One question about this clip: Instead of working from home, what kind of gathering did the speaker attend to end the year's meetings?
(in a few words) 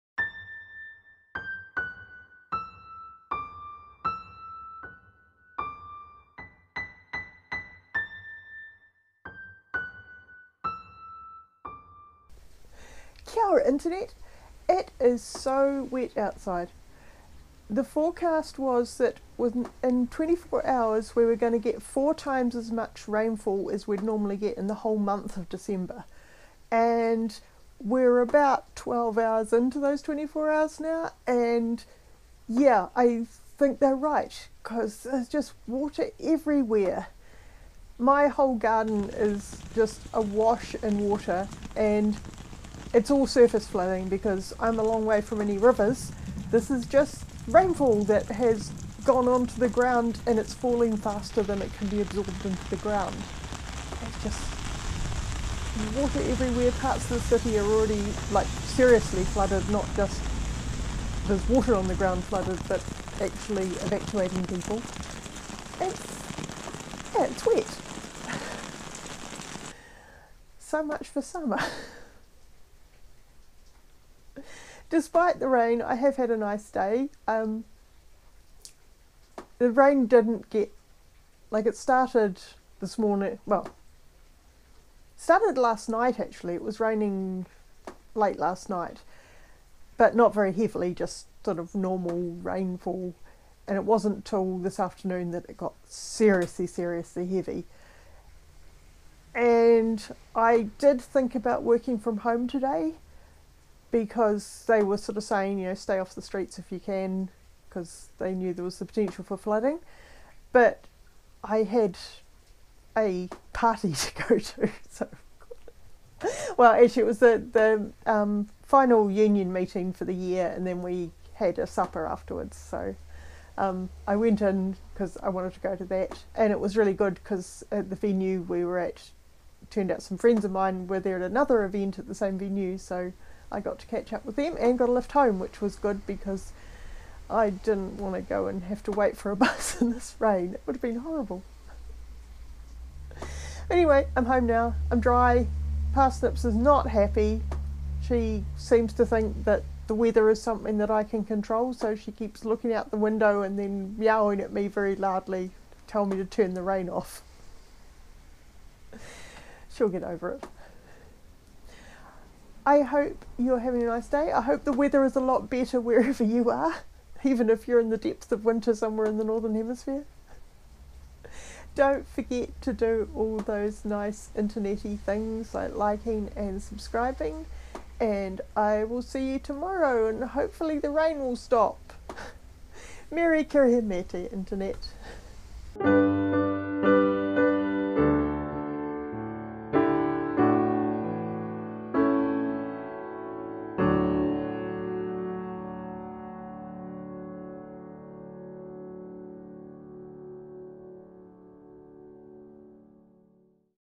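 union meeting.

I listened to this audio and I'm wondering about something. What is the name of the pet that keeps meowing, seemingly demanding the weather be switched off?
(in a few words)
Parsnips.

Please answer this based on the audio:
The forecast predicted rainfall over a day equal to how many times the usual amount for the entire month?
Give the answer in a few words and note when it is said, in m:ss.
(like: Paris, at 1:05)
4, at 0:21.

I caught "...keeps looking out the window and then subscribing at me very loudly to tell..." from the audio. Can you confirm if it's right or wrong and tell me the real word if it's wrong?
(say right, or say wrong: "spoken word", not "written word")
wrong: "meowing", not "subscribing".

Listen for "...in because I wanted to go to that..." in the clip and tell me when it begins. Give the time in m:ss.
2:04.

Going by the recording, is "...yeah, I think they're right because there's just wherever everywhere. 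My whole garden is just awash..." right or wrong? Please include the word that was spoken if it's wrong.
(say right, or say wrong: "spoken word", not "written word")
wrong: "water", not "wherever".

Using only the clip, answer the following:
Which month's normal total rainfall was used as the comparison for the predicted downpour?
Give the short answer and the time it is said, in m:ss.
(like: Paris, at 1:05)
December, at 0:25.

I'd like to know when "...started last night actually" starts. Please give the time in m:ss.
1:25.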